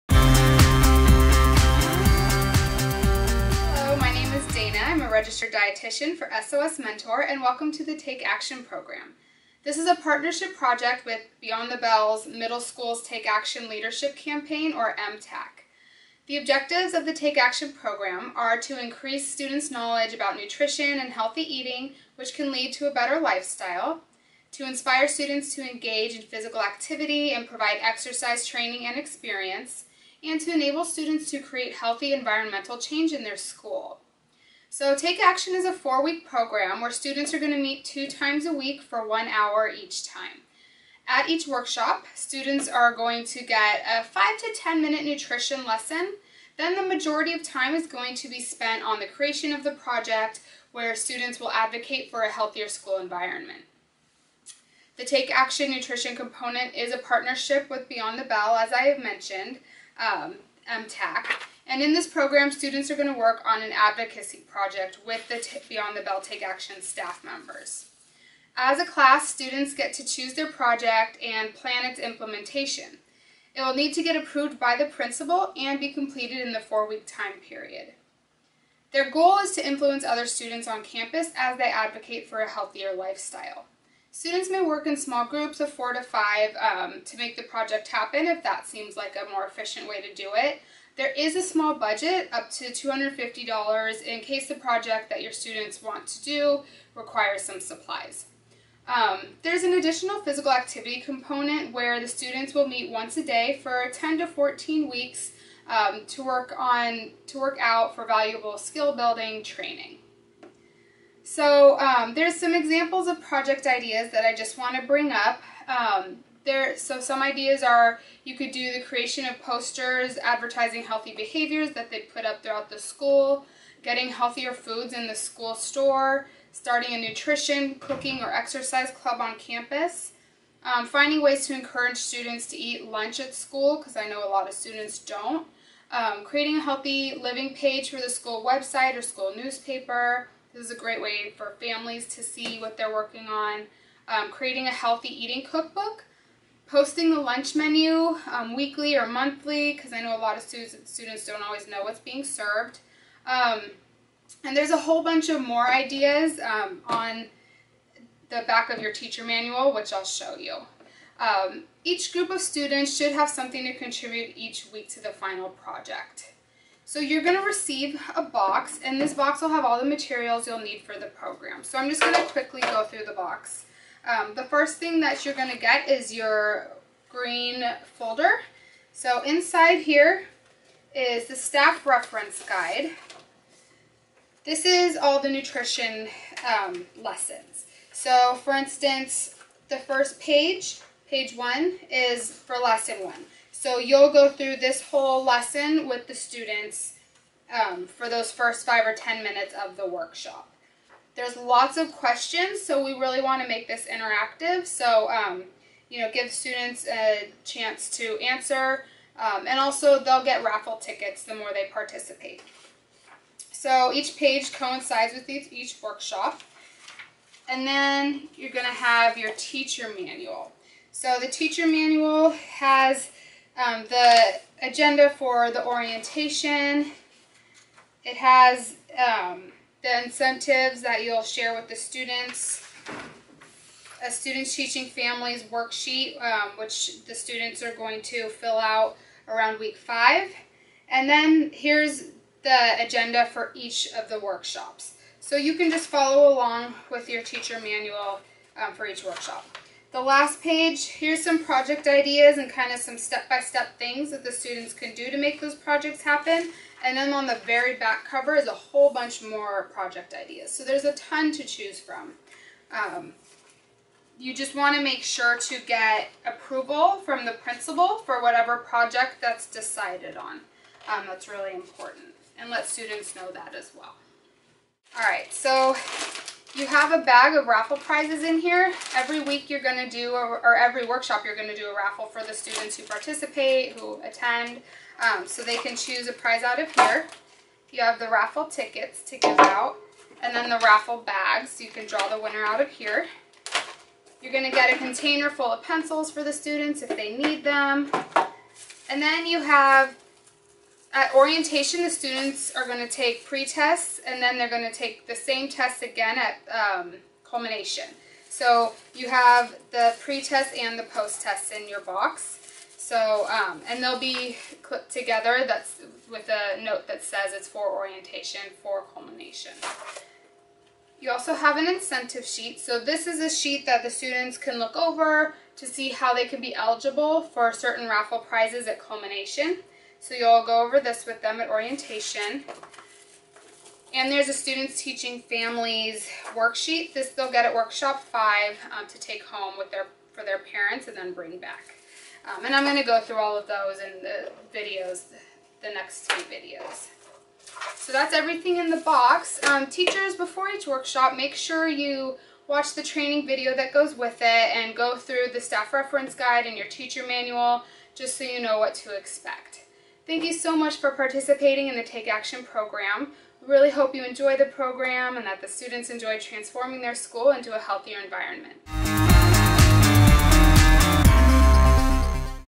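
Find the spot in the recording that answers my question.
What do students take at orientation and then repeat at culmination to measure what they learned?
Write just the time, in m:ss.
5:03.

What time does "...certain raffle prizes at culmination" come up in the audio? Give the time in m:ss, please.
5:27.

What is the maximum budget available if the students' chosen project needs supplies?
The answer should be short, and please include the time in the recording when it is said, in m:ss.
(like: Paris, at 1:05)
$250, at 1:32.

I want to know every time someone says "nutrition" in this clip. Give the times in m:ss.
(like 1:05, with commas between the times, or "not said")
0:20, 0:45, 0:55, 2:07, 3:05.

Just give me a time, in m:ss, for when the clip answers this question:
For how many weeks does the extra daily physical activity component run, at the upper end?
1:44.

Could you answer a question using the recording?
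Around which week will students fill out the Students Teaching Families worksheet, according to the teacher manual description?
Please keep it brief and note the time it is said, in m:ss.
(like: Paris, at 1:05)
Week 5, at 3:59.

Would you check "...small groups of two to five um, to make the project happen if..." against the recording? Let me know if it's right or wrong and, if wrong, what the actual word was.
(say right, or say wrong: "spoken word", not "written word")
wrong: "four", not "two".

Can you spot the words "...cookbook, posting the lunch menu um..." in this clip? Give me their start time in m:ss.
2:25.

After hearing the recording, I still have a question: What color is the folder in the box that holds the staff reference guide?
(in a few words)
Green.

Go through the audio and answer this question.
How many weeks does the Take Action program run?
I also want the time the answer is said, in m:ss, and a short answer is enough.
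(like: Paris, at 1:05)
4, at 0:35.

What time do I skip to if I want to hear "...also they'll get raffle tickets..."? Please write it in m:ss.
3:29.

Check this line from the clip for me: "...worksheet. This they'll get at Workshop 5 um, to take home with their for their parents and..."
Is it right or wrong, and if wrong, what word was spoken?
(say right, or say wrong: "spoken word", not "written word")
right.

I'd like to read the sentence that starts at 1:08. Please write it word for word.
As a class, students get to choose their project and plan its implementation.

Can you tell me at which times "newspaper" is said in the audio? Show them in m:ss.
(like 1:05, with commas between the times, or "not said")
2:19.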